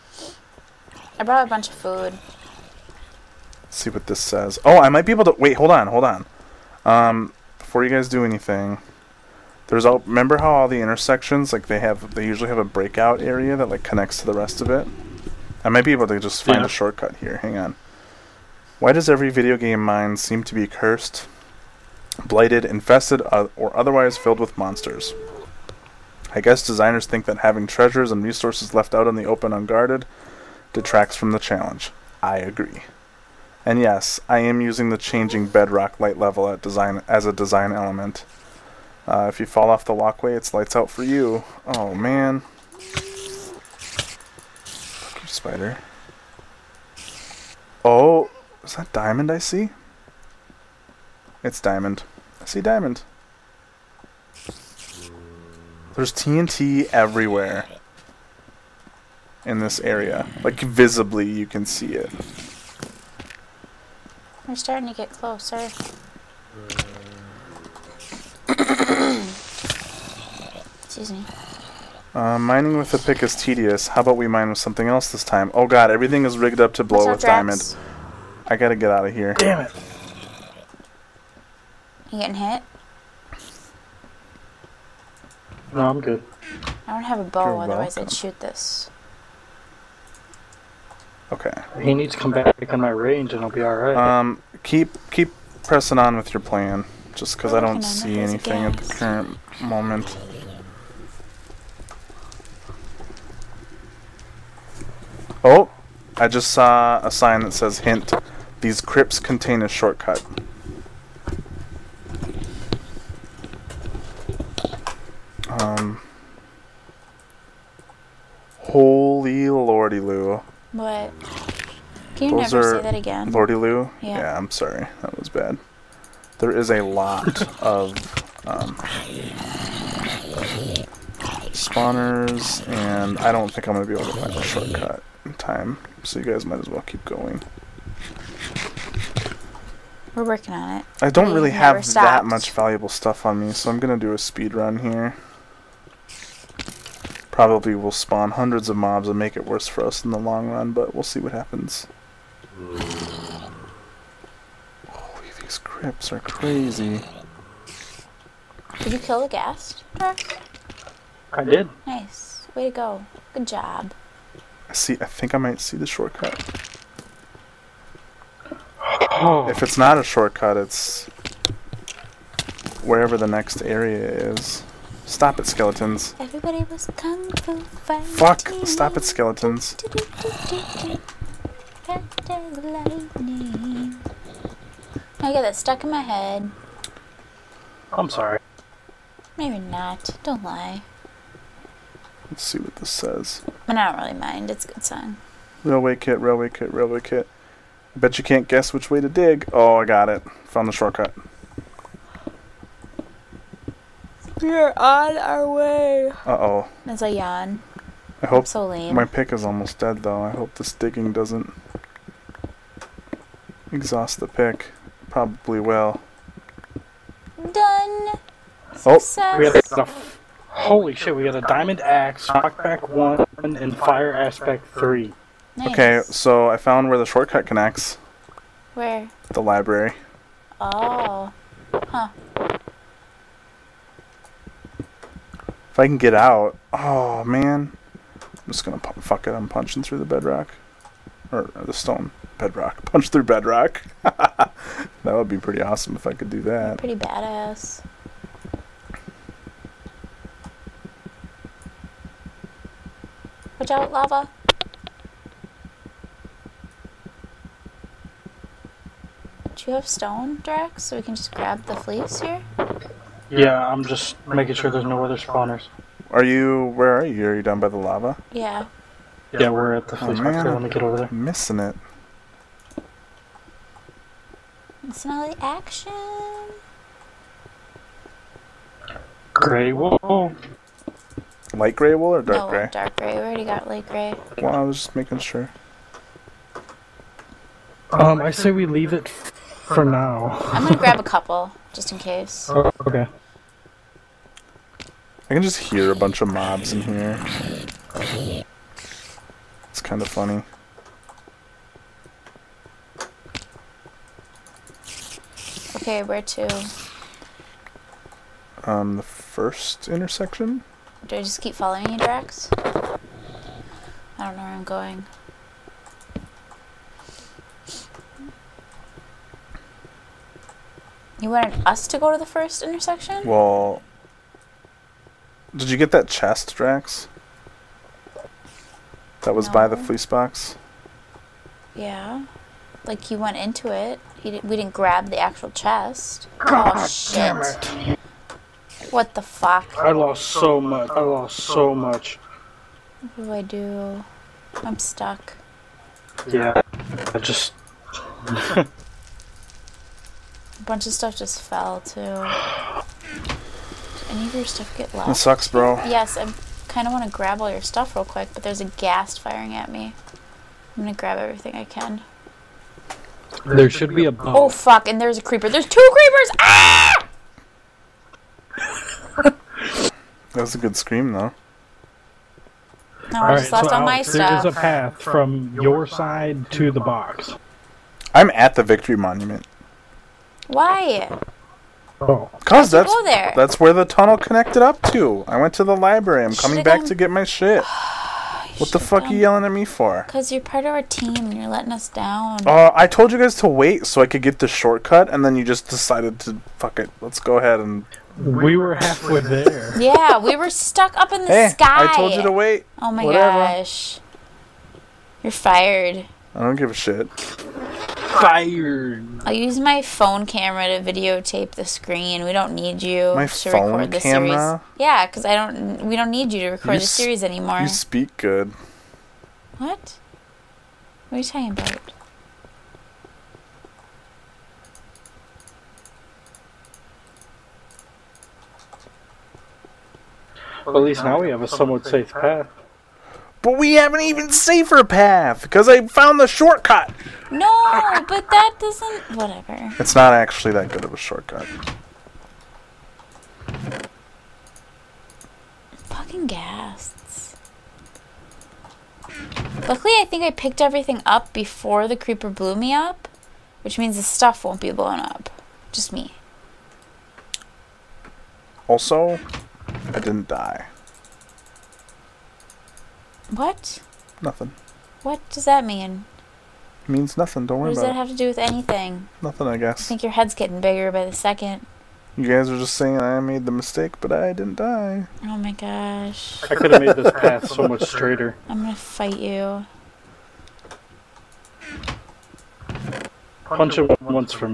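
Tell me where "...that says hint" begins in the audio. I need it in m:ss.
1:47.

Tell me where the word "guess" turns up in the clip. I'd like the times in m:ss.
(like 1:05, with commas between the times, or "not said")
0:26, 3:18, 7:49.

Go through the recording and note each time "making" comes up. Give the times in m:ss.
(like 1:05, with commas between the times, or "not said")
4:24, 4:44.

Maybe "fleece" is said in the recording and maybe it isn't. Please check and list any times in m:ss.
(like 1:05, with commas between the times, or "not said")
4:21, 4:29, 5:29.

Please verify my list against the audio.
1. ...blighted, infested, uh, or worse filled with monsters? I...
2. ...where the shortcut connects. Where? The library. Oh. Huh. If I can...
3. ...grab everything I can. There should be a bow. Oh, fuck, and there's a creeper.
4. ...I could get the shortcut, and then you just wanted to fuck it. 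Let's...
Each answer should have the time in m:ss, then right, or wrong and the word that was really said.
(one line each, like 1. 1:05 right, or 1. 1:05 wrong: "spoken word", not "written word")
1. 0:22 wrong: "otherwise", not "worse"
2. 3:46 right
3. 6:00 right
4. 6:34 wrong: "decided", not "wanted".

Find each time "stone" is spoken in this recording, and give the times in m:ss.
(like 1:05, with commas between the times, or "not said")
4:01, 4:19.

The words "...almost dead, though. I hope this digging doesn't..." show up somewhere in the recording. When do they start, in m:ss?
3:29.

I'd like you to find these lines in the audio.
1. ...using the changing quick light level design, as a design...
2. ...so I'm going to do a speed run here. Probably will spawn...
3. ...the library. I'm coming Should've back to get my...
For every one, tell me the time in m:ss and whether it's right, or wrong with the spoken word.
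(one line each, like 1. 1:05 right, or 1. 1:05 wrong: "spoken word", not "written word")
1. 0:34 wrong: "bedrock", not "quick"
2. 2:23 right
3. 6:25 right.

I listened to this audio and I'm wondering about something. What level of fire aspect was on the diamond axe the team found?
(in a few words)
3.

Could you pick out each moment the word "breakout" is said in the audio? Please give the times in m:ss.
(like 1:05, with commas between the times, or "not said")
0:12.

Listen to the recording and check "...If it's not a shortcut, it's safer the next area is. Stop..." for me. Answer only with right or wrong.
wrong.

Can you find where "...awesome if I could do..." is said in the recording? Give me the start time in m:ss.
4:05.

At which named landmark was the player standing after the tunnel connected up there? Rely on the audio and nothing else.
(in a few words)
Victory Monument.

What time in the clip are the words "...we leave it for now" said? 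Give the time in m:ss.
4:48.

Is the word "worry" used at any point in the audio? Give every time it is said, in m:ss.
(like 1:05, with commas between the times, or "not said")
7:47.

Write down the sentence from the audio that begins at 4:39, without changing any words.
Great wool light gray wool or dark no, gray?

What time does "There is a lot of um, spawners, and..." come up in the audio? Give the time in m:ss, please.
2:06.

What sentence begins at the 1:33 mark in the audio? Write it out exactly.
Um, keep keep pressing on with your plan, just because I don't see anything at the current moment.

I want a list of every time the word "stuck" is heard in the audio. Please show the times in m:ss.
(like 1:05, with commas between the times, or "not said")
3:05, 5:44, 6:40.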